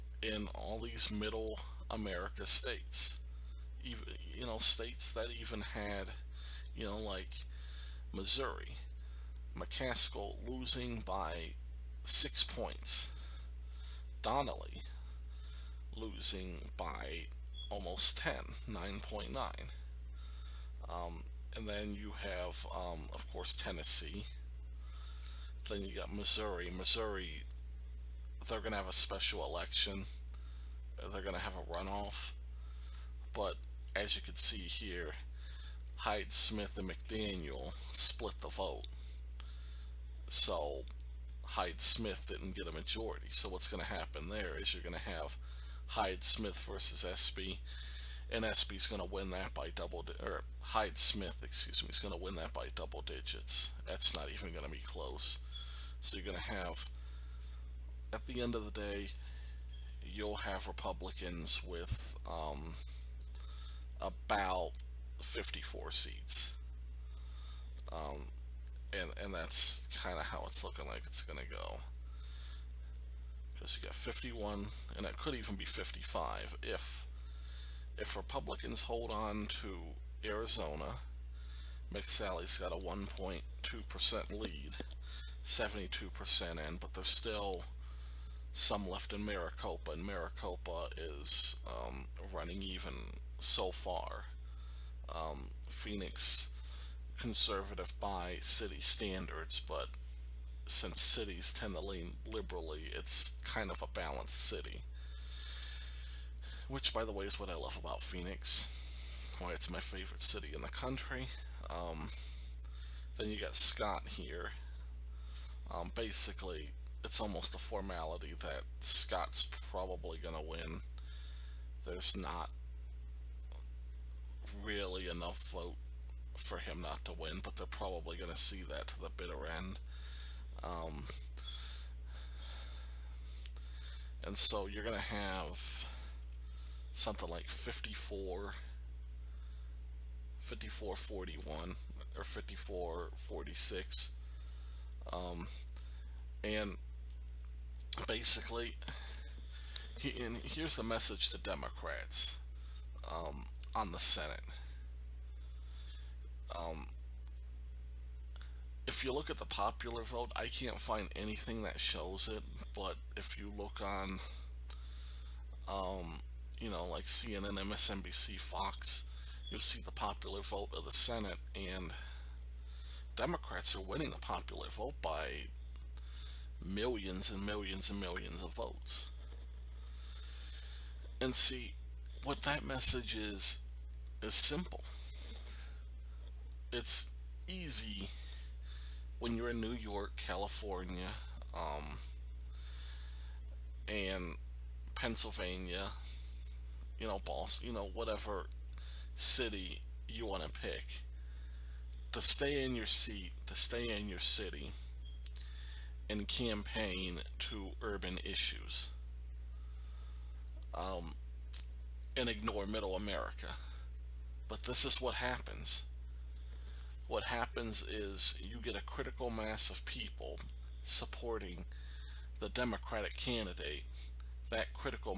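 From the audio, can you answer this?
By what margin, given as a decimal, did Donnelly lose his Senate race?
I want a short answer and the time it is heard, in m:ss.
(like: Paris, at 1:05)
9.9, at 0:18.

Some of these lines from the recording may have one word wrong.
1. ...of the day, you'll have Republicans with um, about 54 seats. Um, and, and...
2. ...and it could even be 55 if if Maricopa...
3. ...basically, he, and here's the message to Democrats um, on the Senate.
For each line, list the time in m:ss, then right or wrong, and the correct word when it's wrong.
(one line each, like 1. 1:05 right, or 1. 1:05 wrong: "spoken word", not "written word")
1. 0:58 right
2. 1:14 wrong: "Republicans", not "Maricopa"
3. 2:28 right.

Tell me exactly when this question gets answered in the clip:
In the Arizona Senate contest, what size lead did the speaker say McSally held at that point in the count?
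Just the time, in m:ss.
1:22.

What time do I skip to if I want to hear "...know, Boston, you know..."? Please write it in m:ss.
3:17.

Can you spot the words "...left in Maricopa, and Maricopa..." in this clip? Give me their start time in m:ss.
1:28.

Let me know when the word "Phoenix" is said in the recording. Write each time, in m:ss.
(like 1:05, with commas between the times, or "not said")
1:35, 1:48.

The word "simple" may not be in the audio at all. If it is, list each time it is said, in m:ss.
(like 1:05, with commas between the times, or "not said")
3:04.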